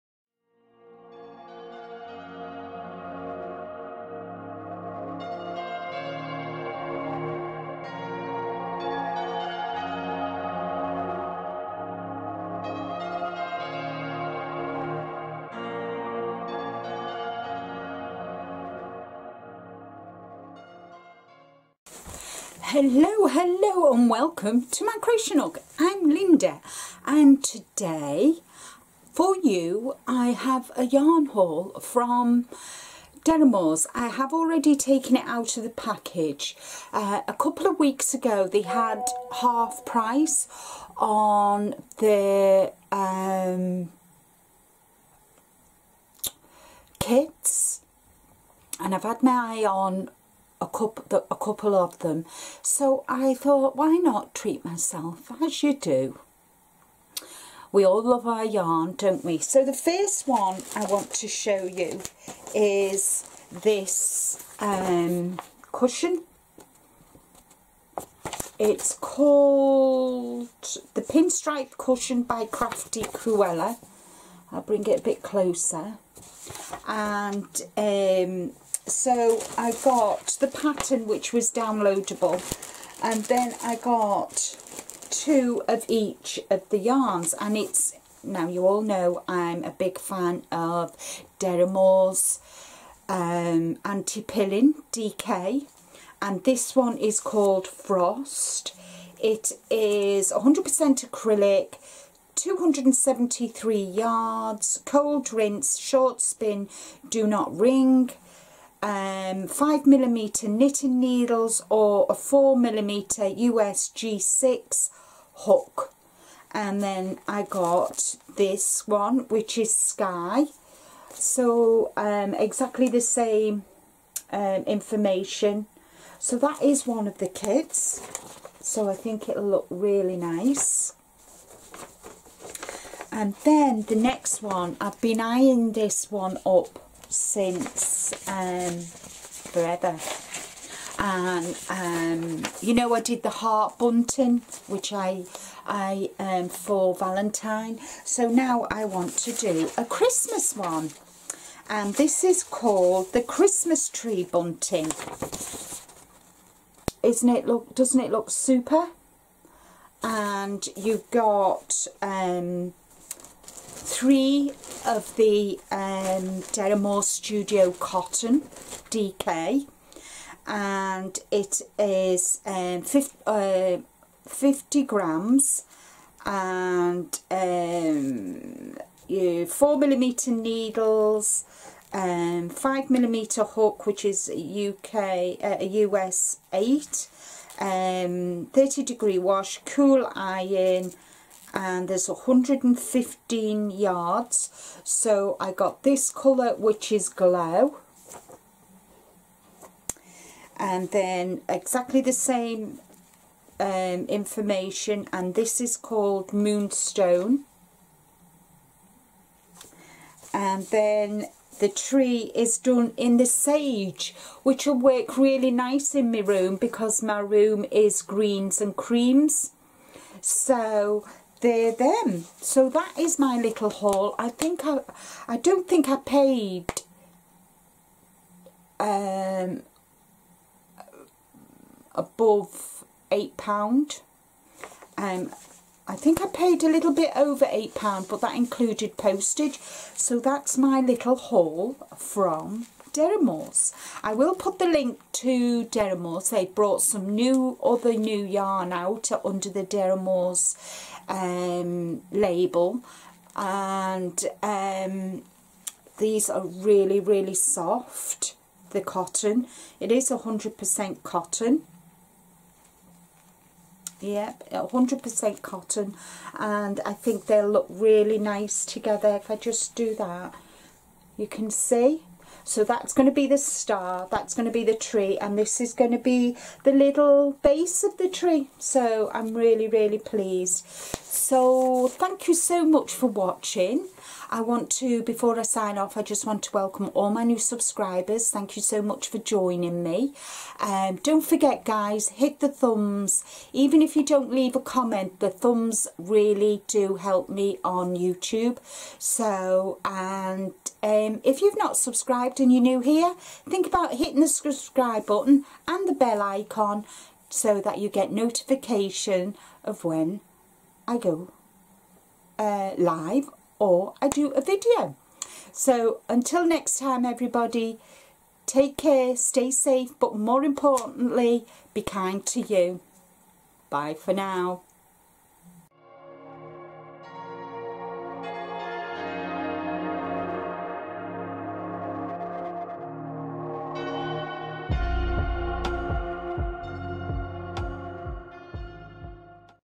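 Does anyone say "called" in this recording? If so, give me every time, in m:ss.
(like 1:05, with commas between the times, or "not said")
1:08, 1:37, 2:32, 3:25.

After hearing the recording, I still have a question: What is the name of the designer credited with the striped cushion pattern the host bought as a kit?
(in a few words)
Crafty Cruella.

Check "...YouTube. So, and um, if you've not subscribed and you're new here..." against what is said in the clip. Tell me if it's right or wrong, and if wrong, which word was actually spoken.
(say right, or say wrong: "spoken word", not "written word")
right.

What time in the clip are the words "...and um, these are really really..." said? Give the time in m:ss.
4:13.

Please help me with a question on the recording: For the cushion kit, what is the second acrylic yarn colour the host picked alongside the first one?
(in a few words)
Sky.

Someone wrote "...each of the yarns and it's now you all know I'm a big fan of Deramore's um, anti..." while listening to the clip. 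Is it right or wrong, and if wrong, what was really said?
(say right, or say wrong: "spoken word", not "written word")
right.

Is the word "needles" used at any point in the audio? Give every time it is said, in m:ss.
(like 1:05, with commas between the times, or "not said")
1:50, 3:00.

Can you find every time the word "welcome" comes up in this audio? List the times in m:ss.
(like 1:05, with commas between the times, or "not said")
0:24, 4:46.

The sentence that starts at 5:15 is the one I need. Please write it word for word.
So until next time everybody, take care, stay safe, but more importantly, be kind to you.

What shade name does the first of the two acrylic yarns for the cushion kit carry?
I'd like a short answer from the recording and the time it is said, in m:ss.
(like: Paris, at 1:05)
Frost, at 1:37.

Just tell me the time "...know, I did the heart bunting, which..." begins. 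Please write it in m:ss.
2:22.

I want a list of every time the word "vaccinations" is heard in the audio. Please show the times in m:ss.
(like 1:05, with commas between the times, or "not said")
not said.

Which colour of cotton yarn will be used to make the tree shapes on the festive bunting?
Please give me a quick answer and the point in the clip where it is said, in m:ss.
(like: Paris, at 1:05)
Sage, at 3:33.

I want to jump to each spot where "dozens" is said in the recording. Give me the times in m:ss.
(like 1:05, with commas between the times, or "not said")
not said.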